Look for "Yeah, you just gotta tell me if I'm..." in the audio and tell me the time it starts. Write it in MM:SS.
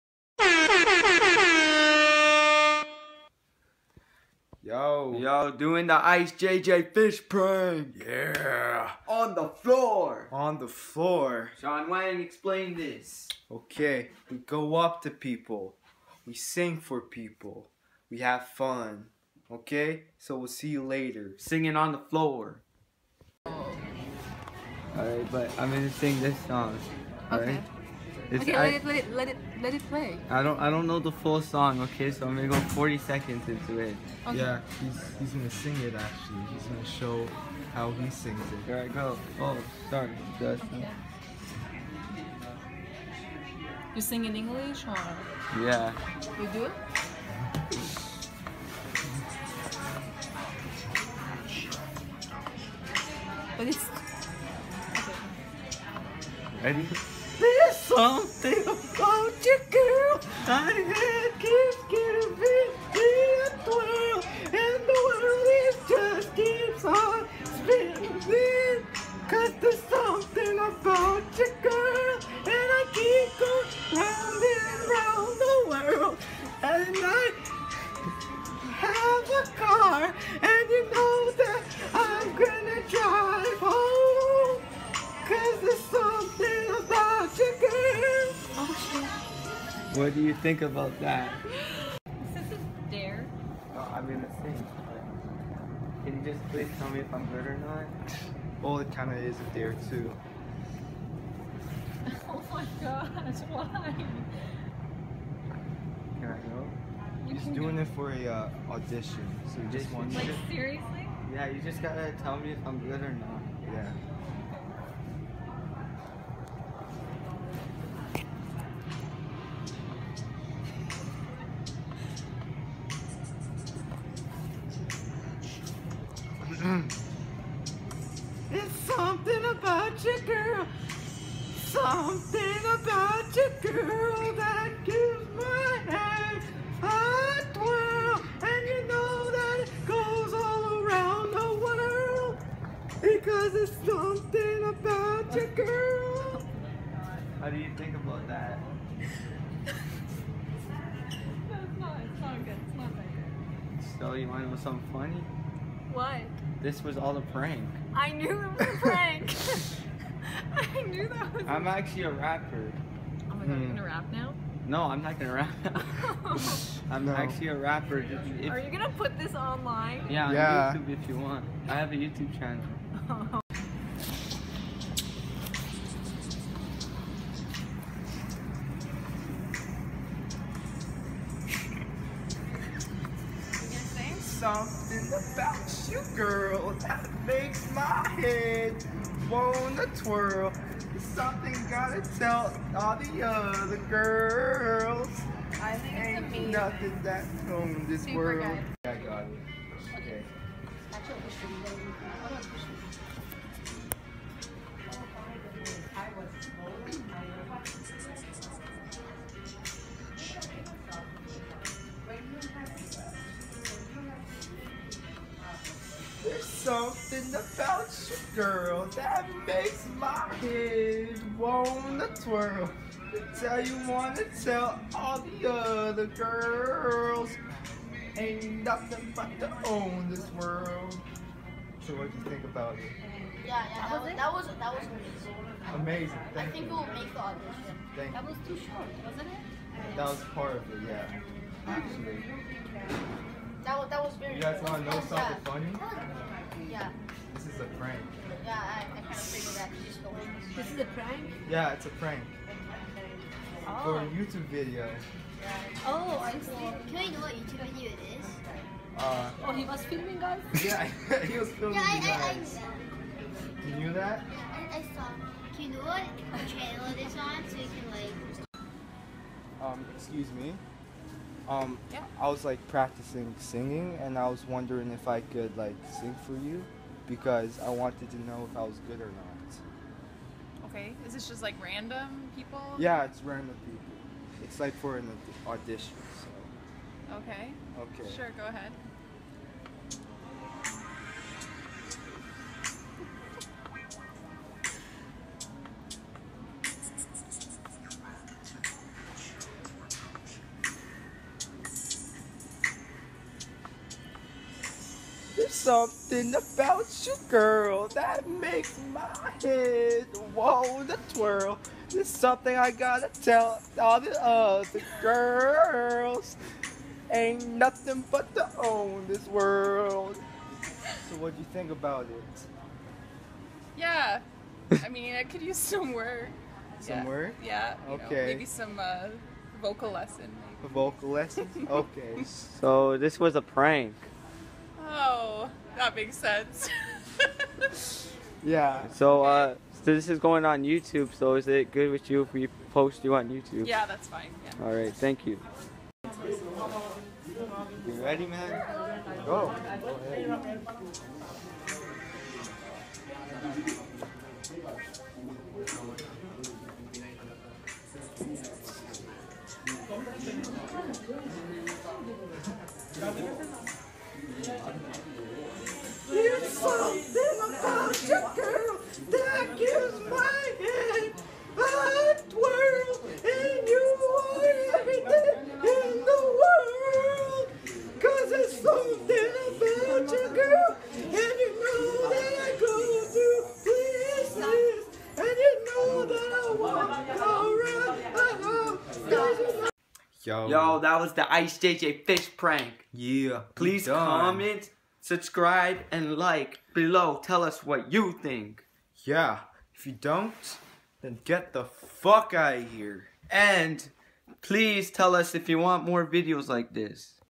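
01:51.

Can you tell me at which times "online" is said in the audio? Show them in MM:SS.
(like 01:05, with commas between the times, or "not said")
02:49.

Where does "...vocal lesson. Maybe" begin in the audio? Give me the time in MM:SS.
05:29.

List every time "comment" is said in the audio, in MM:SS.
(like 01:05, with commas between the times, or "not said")
06:33.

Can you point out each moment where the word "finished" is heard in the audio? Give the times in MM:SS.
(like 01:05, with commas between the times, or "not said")
not said.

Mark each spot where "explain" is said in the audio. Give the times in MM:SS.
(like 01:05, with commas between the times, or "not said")
00:12.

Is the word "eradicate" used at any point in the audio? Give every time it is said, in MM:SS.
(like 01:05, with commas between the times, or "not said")
not said.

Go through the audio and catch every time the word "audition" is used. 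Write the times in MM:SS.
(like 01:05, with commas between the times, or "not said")
01:48, 03:57, 04:45.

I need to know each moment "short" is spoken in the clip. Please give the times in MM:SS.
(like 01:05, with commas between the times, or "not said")
03:58.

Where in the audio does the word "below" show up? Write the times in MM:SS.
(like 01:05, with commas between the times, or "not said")
06:36.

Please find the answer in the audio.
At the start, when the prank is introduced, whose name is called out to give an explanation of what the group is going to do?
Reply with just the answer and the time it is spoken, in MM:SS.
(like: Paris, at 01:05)
Sean Wang, at 00:11.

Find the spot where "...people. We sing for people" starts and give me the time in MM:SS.
00:15.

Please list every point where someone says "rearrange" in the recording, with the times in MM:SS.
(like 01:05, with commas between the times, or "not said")
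not said.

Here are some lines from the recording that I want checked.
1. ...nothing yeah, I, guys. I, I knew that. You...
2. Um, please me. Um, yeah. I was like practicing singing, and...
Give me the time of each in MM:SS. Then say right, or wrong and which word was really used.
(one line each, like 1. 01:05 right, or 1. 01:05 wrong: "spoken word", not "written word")
1. 04:21 wrong: "filming", not "nothing"
2. 04:29 wrong: "excuse", not "please".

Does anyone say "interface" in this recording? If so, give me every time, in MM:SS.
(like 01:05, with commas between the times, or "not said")
not said.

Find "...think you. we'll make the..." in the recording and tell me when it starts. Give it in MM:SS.
03:56.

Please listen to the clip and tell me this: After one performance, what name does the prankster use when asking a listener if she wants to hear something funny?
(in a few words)
Shelly.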